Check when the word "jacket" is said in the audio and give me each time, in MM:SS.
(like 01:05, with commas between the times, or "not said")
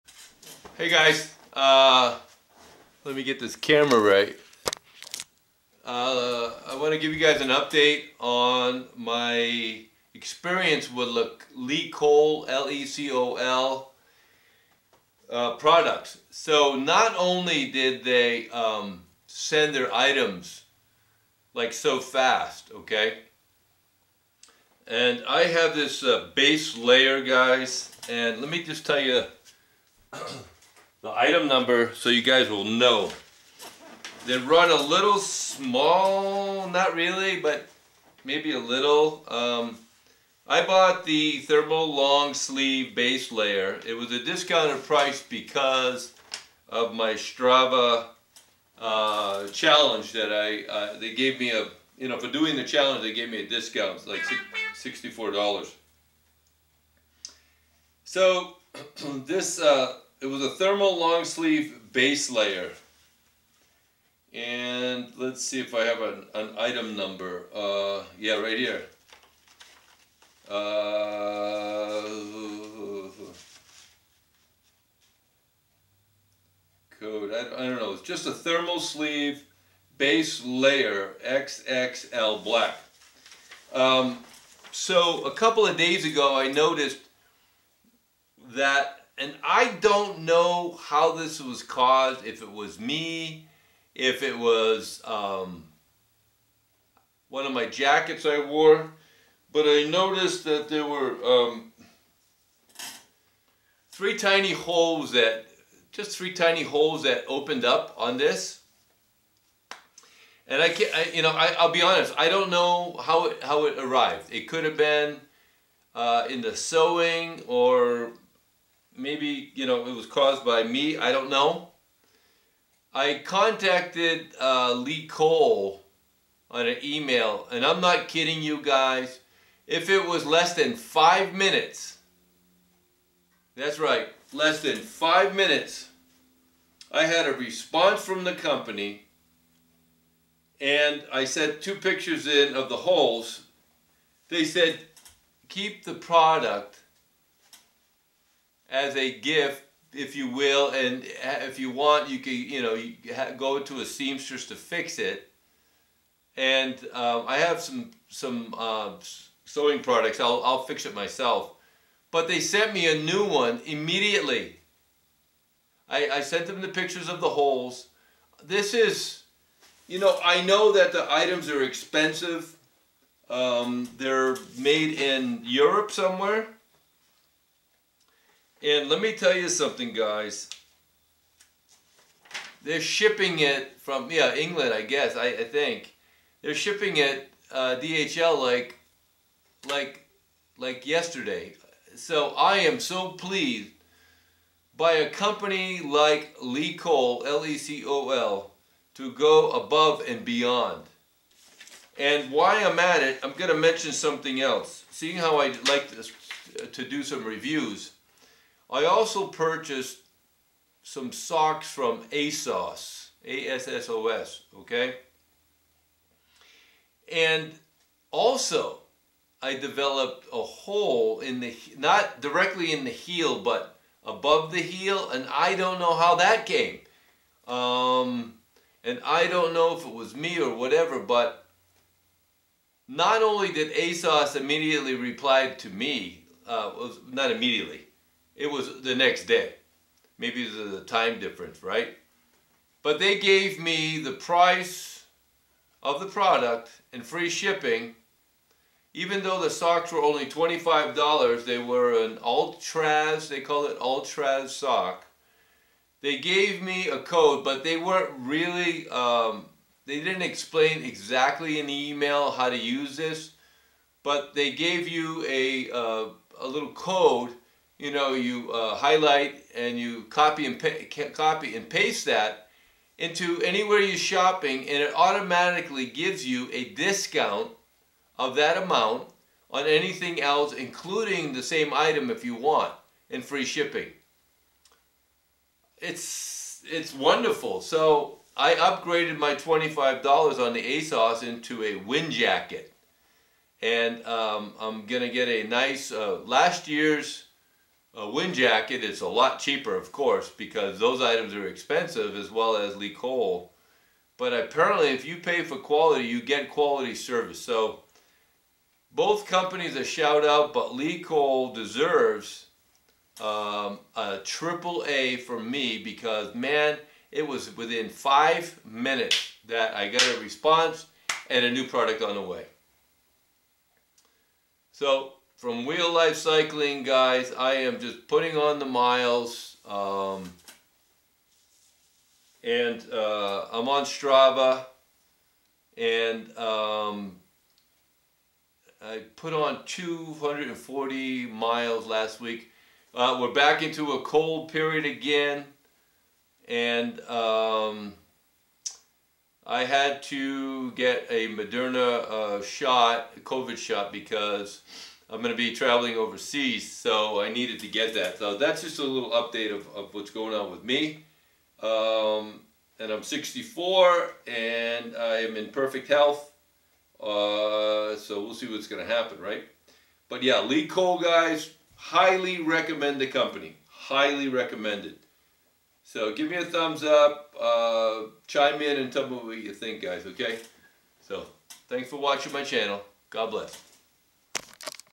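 01:37, 04:52, 04:58.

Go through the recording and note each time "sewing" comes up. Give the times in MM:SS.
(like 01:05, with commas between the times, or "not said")
01:56, 02:39.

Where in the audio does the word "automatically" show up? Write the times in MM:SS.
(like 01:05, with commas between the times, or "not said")
04:34.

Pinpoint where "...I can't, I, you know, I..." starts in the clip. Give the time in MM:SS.
01:50.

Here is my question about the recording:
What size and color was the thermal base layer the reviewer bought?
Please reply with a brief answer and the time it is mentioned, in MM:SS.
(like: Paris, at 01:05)
XXL black, at 01:21.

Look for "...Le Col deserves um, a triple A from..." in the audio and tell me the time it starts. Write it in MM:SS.
05:10.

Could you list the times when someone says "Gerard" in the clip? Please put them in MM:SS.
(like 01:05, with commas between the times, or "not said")
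not said.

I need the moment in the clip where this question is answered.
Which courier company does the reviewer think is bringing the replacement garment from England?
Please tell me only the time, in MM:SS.
03:07.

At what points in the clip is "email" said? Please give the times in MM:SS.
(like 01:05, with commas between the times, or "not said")
02:06, 04:21.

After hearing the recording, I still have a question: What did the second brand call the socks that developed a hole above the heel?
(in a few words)
ultra sock.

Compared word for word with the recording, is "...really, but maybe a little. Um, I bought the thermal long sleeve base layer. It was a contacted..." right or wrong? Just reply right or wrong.
wrong.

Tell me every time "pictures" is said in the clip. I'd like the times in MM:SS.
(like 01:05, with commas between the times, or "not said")
02:21, 02:46.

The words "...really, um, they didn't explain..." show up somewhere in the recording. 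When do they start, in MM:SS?
04:18.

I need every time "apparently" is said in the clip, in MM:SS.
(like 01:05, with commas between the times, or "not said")
05:04.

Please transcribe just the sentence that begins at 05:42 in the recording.
Uh, we're back into a cold period again.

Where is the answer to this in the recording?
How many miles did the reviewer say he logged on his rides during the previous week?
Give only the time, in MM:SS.
05:39.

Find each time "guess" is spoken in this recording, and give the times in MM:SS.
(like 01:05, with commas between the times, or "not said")
03:04.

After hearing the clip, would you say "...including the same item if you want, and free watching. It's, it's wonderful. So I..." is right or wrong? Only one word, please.
wrong.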